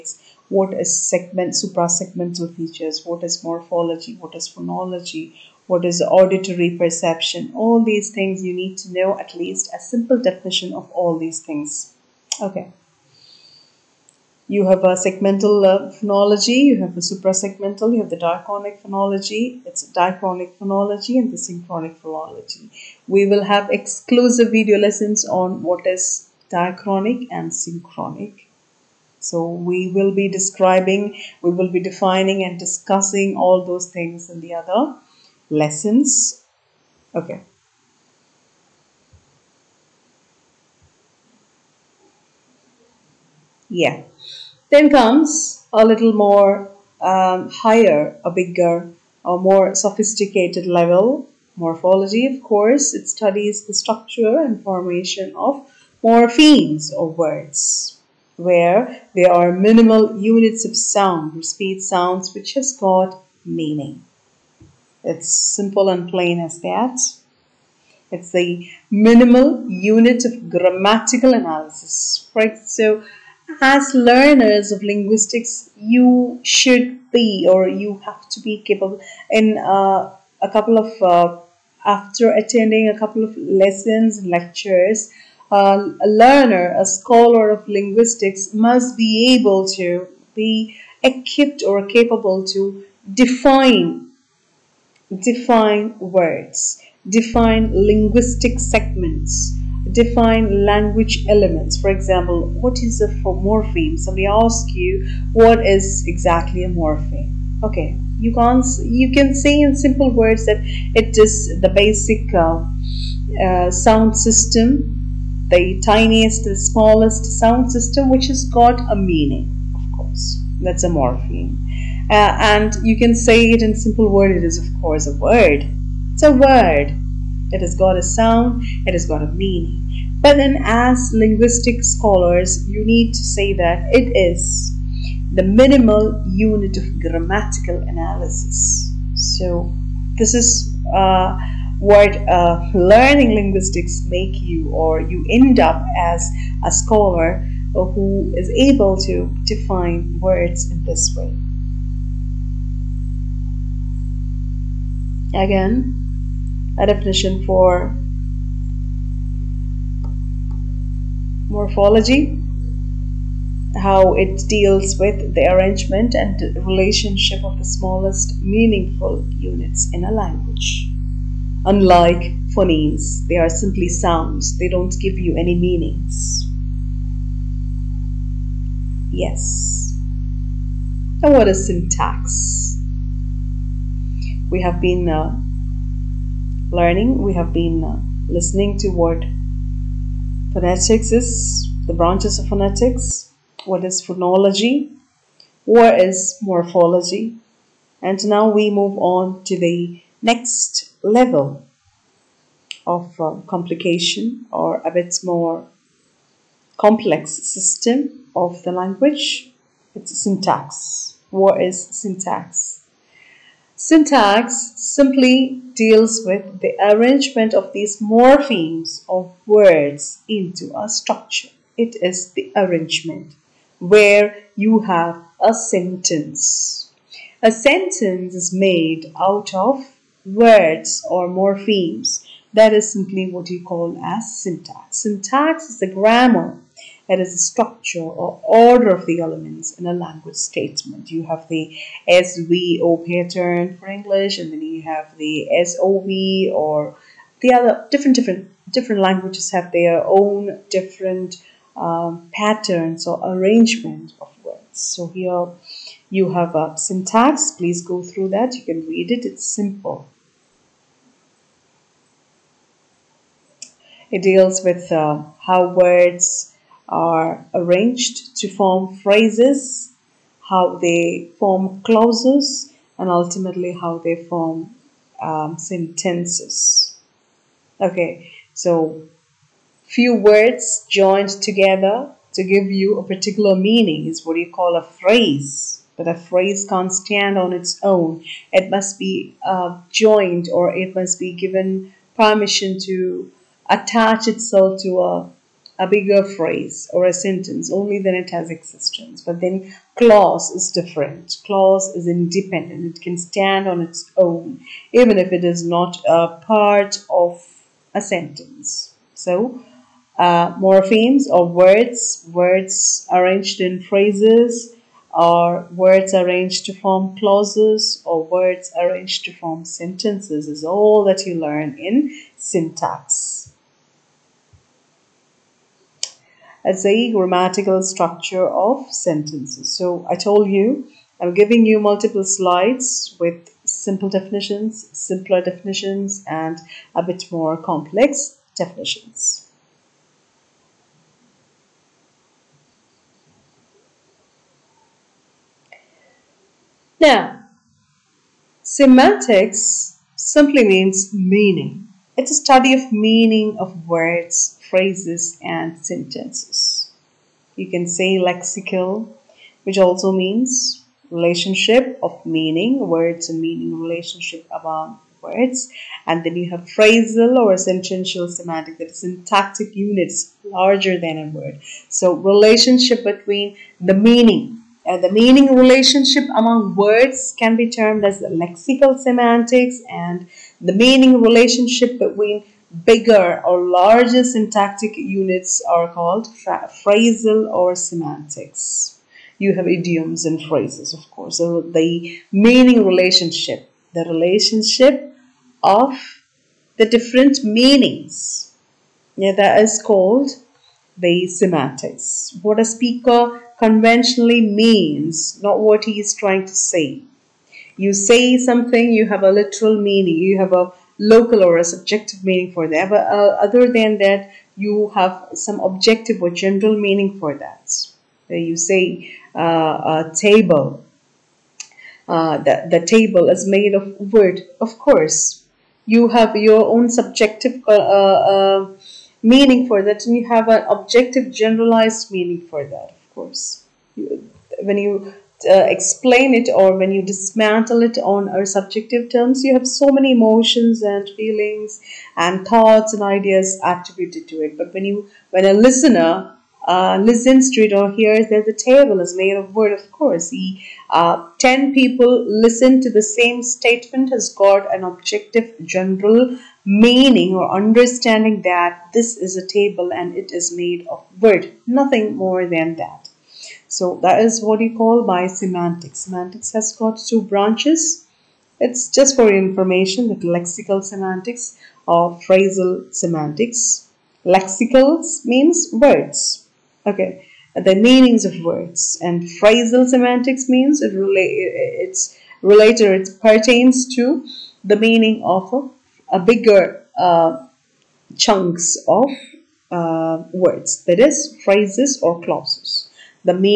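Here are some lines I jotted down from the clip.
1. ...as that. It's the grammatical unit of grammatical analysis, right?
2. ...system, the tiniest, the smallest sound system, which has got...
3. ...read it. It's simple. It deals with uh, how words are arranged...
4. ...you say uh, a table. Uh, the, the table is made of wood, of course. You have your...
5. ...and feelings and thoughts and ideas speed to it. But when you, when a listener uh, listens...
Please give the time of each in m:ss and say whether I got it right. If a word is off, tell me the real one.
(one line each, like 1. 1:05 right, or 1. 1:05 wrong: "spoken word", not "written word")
1. 1:06 wrong: "minimal", not "grammatical"
2. 1:54 right
3. 4:18 right
4. 6:58 right
5. 7:20 wrong: "attributed", not "speed".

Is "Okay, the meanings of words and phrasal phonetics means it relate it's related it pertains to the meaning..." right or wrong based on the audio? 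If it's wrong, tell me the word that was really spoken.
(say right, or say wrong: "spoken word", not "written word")
wrong: "semantics", not "phonetics".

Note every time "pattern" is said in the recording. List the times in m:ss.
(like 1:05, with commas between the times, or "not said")
4:03, 4:12.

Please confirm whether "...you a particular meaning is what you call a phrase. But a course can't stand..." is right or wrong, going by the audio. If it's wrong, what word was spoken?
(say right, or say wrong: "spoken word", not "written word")
wrong: "phrase", not "course".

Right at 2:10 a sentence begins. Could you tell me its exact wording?
But then, as linguistic scholars, you need to say that it is the minimal unit of grammatical analysis.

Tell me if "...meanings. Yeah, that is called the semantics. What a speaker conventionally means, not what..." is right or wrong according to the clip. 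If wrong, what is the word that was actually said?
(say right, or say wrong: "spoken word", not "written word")
right.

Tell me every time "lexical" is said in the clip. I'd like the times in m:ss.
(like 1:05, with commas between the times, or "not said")
5:58, 6:18, 7:50, 7:54.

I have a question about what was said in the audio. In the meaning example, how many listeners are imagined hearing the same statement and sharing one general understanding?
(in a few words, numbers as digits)
10.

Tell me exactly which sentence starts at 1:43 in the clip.
Somebody asks you, what is exactly a morpheme?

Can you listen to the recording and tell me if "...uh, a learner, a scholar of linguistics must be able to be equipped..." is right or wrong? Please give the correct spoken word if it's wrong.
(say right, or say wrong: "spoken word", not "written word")
right.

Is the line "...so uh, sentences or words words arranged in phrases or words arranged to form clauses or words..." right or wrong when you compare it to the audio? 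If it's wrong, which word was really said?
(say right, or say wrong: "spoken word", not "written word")
wrong: "morphemes", not "sentences".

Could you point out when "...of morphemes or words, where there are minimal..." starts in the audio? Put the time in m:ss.
0:55.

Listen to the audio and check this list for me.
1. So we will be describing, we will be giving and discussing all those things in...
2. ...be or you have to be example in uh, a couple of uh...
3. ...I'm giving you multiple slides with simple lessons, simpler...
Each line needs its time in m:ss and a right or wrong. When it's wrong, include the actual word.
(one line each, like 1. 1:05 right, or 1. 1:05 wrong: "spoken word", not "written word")
1. 0:29 wrong: "defining", not "giving"
2. 1:17 wrong: "capable", not "example"
3. 5:31 wrong: "definitions", not "lessons".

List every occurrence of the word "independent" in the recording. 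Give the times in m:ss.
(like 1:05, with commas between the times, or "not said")
5:02.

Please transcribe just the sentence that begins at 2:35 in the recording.
Again, a definition for morphology, how it deals with the arrangement and relationship of the smallest meaningful units in a language.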